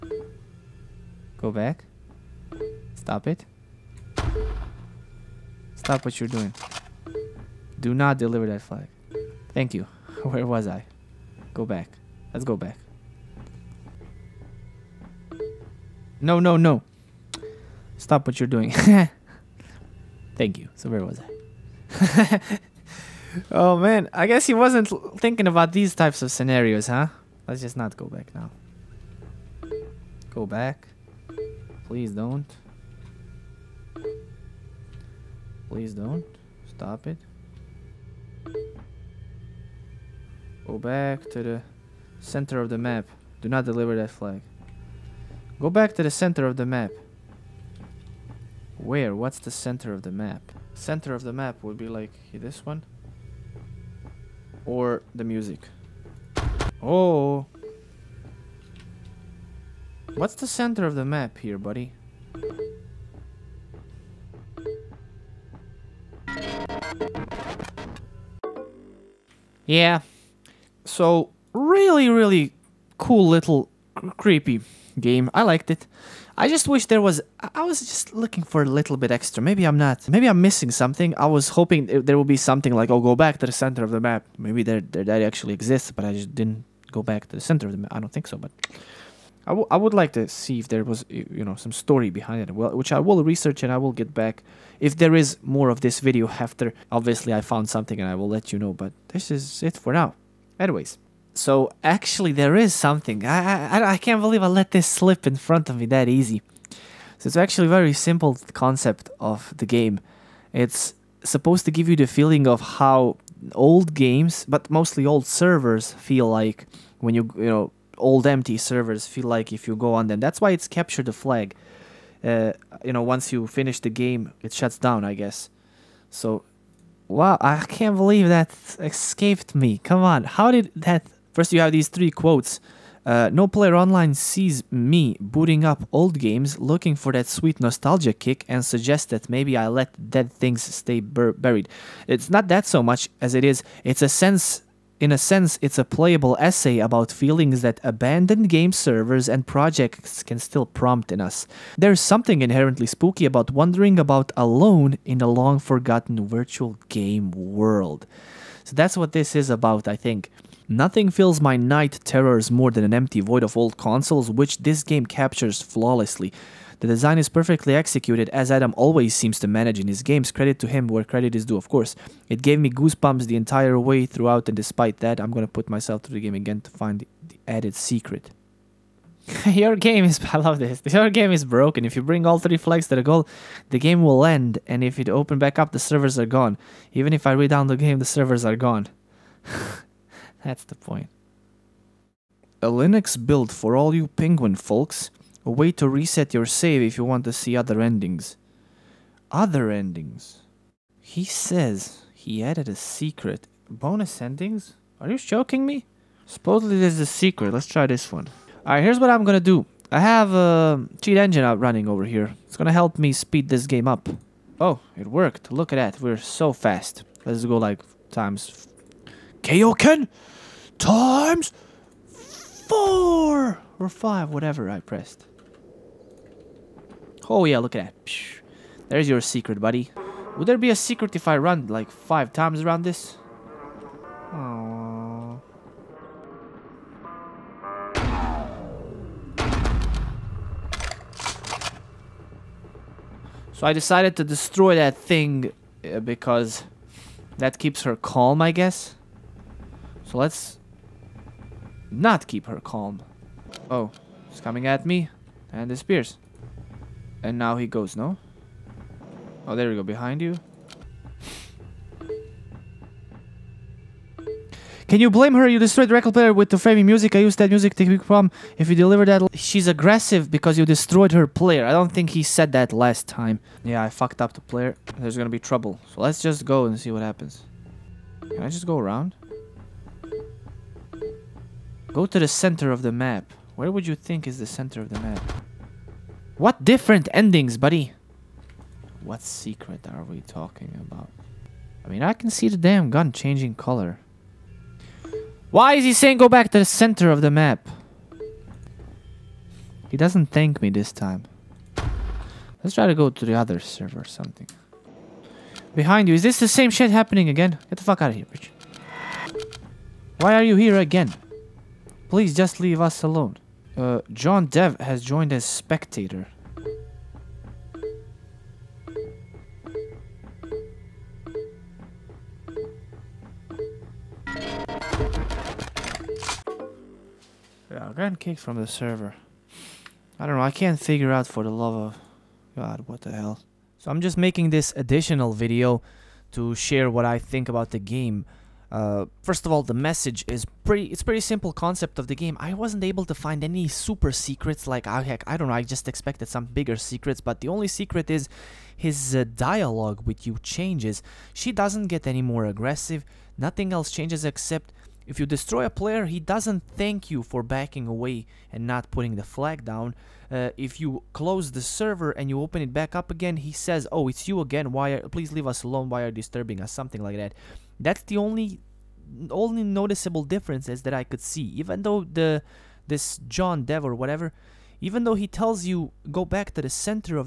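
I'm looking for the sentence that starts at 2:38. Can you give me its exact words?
So that's what this is about, I think.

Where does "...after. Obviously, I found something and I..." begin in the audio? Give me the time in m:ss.
1:36.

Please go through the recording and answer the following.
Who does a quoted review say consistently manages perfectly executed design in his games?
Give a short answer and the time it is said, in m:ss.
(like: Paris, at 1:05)
Adam, at 2:48.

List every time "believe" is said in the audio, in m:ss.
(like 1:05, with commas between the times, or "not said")
1:44, 2:07.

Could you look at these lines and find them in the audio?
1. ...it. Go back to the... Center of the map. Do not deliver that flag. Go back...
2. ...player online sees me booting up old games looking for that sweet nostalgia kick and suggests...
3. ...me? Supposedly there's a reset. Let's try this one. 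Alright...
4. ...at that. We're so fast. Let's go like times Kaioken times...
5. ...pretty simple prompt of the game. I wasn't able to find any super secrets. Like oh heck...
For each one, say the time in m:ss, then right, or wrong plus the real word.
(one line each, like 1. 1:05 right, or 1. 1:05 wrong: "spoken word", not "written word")
1. 0:37 right
2. 2:13 right
3. 3:25 wrong: "secret", not "reset"
4. 3:35 right
5. 5:41 wrong: "concept", not "prompt".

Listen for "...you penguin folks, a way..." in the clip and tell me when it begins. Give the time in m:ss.
3:13.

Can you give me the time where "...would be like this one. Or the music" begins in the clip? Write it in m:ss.
0:51.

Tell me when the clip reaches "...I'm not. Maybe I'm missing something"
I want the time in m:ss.
1:19.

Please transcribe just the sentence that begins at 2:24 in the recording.
In a sense, it's a playable essay about feelings that abandoned game servers and projects can still prompt in us.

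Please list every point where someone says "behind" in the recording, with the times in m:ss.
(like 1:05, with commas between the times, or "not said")
1:32, 4:19, 5:05.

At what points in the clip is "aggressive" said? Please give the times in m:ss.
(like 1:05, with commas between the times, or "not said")
4:29, 5:52.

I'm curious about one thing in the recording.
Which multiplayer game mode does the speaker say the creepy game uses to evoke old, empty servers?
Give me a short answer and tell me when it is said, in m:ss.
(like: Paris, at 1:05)
Capture the flag, at 2:00.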